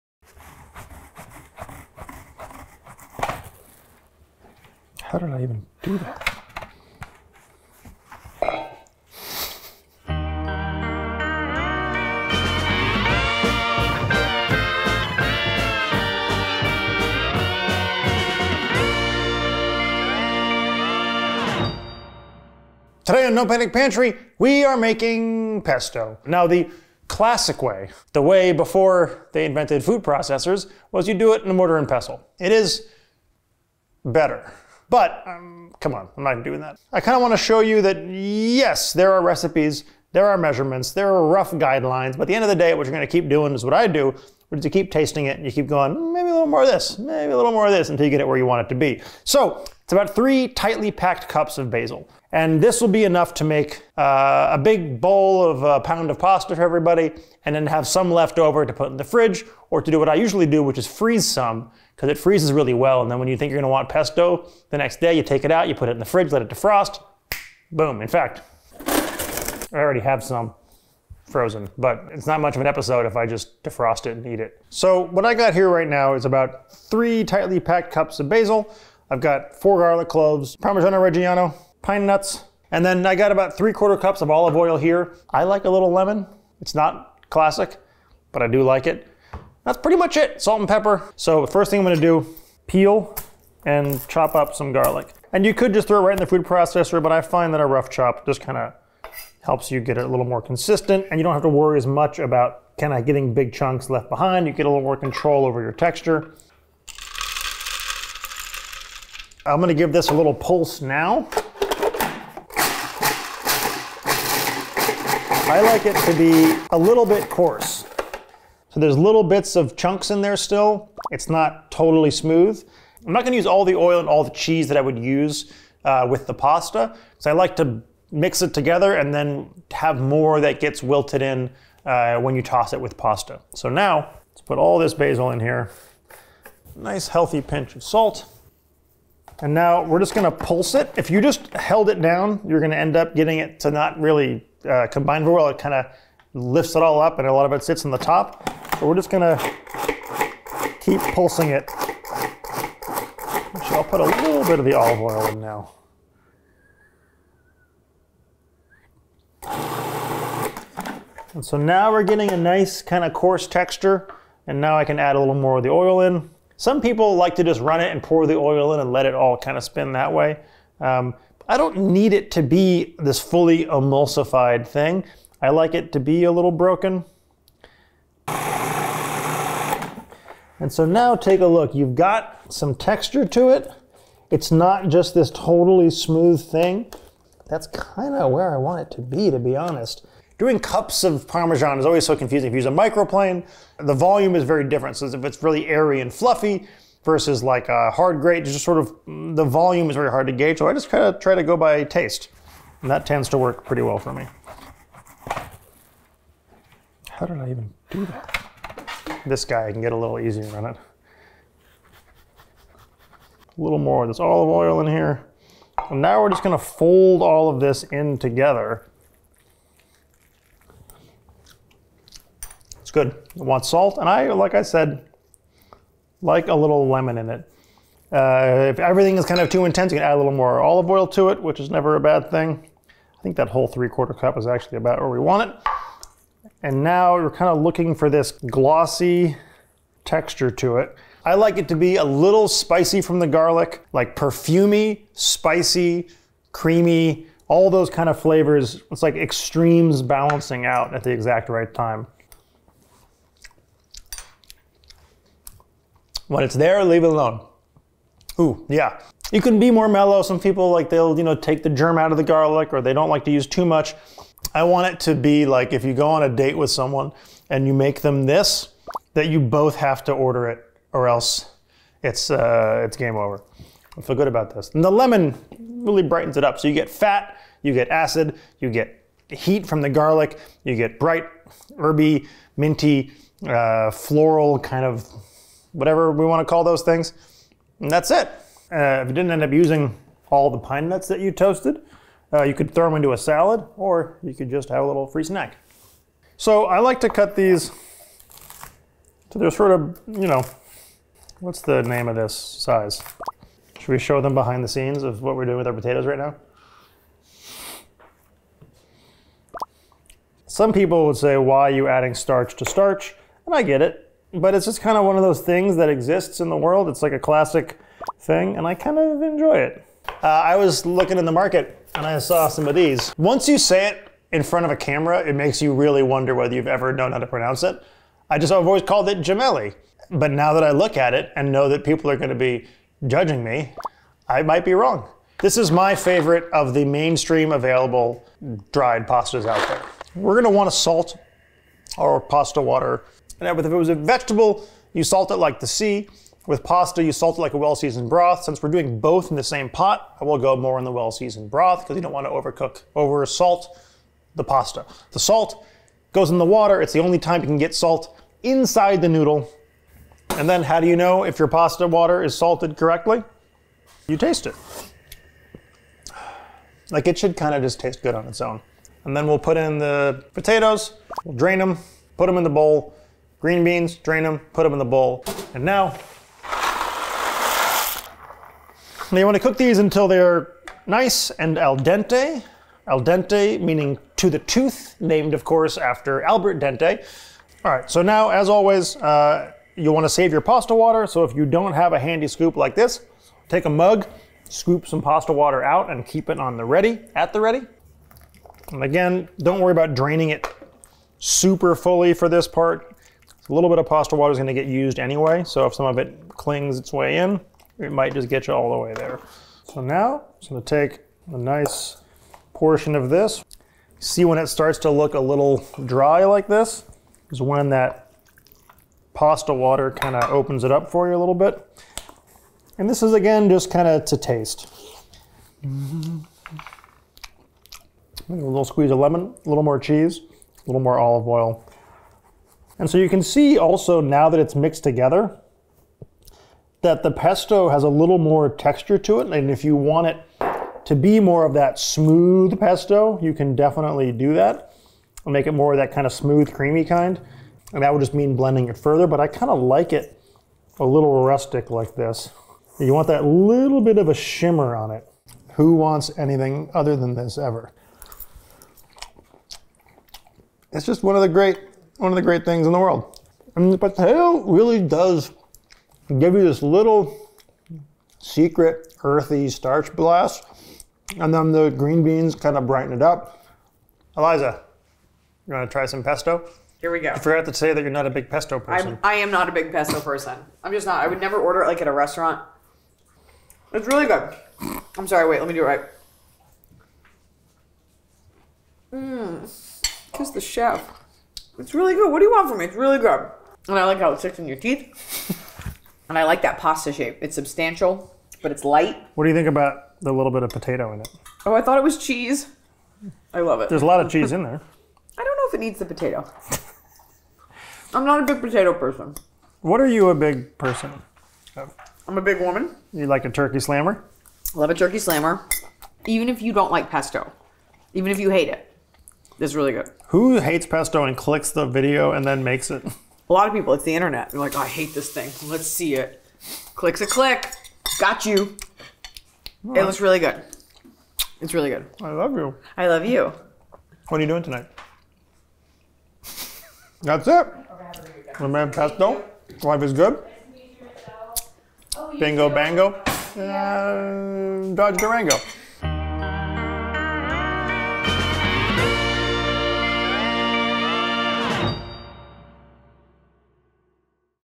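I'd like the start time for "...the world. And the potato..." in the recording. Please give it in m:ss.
7:42.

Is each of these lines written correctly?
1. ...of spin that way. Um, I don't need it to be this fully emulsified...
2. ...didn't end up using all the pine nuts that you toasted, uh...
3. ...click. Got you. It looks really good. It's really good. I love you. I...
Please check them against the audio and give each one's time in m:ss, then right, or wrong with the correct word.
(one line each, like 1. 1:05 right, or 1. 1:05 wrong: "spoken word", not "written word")
1. 2:49 right
2. 4:49 right
3. 8:47 right.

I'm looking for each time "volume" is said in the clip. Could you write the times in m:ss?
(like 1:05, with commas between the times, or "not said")
3:13, 3:19.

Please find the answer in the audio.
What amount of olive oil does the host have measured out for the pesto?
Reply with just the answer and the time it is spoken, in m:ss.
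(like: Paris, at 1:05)
3/4 cup, at 1:23.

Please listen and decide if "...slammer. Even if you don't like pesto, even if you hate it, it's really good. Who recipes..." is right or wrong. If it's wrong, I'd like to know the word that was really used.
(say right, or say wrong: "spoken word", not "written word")
wrong: "hates", not "recipes".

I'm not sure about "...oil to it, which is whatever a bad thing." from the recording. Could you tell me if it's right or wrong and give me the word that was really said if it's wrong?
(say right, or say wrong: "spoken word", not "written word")
wrong: "never", not "whatever".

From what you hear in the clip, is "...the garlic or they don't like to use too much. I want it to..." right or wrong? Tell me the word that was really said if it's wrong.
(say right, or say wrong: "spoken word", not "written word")
right.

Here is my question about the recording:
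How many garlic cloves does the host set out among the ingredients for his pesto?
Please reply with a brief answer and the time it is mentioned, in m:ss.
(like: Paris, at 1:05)
4, at 1:19.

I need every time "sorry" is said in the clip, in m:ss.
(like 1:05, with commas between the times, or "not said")
8:05.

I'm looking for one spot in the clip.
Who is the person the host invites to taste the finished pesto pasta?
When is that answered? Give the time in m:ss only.
7:54.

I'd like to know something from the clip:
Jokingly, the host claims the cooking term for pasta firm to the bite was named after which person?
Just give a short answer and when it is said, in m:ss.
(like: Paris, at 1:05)
Albert Dente, at 6:26.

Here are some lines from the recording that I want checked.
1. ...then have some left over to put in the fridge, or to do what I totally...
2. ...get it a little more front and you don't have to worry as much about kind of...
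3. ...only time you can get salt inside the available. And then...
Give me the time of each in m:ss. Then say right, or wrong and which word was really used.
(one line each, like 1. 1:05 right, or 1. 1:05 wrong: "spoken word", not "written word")
1. 0:57 wrong: "usually", not "totally"
2. 1:39 wrong: "consistent", not "front"
3. 5:56 wrong: "noodle", not "available".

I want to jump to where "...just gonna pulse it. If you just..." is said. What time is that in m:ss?
2:19.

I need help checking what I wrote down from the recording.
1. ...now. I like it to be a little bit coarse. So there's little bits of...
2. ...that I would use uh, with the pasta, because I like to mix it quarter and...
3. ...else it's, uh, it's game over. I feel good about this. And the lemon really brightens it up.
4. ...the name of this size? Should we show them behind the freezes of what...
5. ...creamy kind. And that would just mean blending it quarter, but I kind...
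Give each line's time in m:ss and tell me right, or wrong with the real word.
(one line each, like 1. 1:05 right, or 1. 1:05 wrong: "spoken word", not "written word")
1. 1:50 right
2. 2:04 wrong: "together", not "quarter"
3. 4:31 right
4. 5:01 wrong: "scenes", not "freezes"
5. 7:26 wrong: "further", not "quarter".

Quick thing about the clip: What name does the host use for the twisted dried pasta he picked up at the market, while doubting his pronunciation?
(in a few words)
Gemelli.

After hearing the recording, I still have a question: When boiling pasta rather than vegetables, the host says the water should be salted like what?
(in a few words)
A well-seasoned broth.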